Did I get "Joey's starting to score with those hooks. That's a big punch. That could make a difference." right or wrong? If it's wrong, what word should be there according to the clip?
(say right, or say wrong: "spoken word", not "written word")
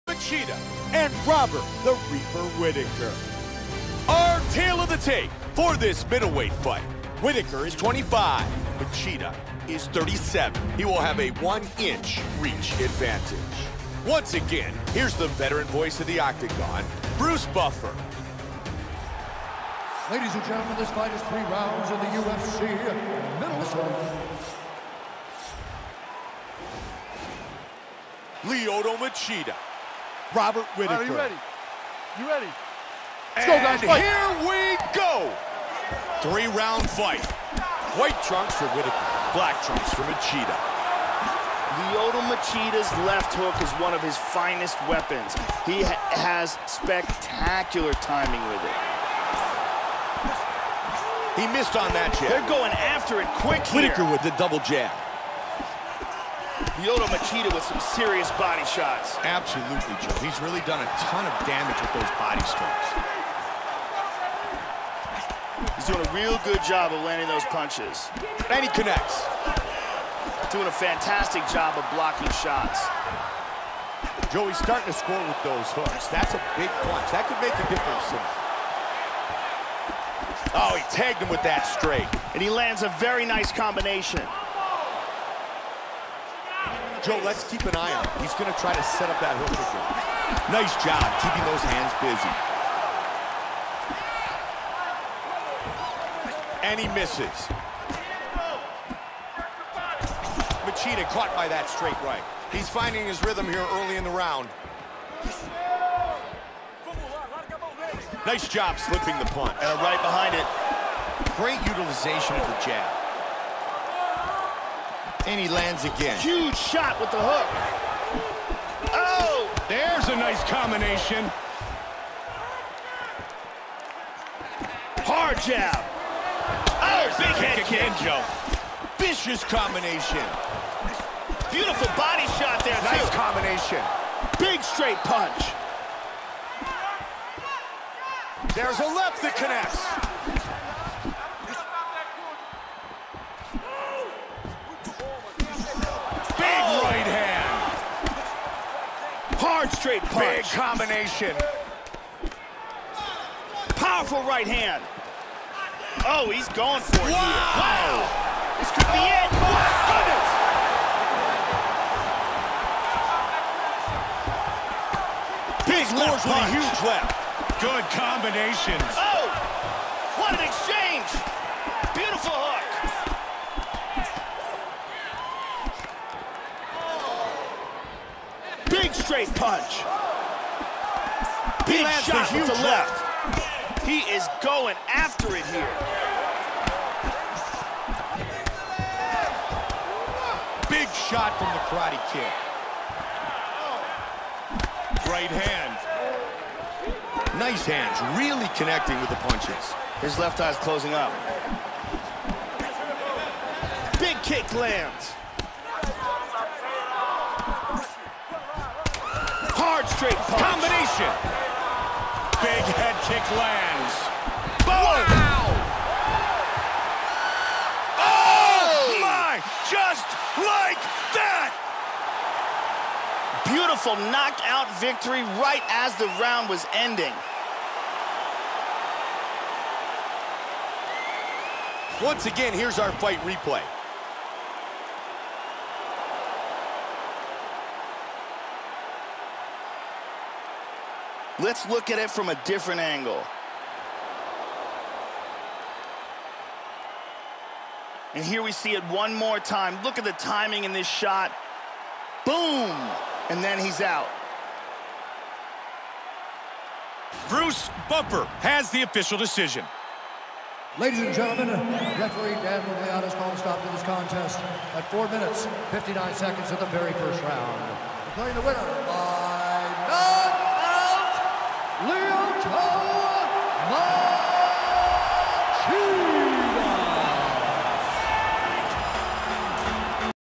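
right.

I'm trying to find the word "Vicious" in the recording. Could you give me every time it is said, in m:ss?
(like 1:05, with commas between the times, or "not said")
2:08.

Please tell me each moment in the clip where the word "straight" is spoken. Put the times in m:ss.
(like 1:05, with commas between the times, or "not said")
1:21, 1:41, 2:14, 2:29, 2:59, 3:30.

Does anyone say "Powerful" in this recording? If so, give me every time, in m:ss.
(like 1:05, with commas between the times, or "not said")
2:33.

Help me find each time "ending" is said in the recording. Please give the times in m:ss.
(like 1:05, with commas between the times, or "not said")
3:46.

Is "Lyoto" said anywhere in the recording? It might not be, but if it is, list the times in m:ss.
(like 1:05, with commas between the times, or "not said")
0:28, 0:41, 0:56.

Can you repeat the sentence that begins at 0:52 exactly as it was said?
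They're going after it quick Whitaker with the double jab.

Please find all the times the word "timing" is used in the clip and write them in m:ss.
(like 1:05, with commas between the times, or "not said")
0:47, 4:10.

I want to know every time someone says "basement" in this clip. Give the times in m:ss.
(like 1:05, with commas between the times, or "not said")
not said.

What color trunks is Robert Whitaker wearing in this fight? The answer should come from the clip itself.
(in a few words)
White.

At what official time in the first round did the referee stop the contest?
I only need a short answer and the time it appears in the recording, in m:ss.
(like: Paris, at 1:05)
4:59, at 4:24.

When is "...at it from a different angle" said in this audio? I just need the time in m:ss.
4:01.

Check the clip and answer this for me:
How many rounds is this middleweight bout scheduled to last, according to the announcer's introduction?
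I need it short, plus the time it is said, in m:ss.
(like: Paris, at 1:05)
3, at 0:21.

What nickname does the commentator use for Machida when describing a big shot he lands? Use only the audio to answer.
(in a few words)
The Karate Kid.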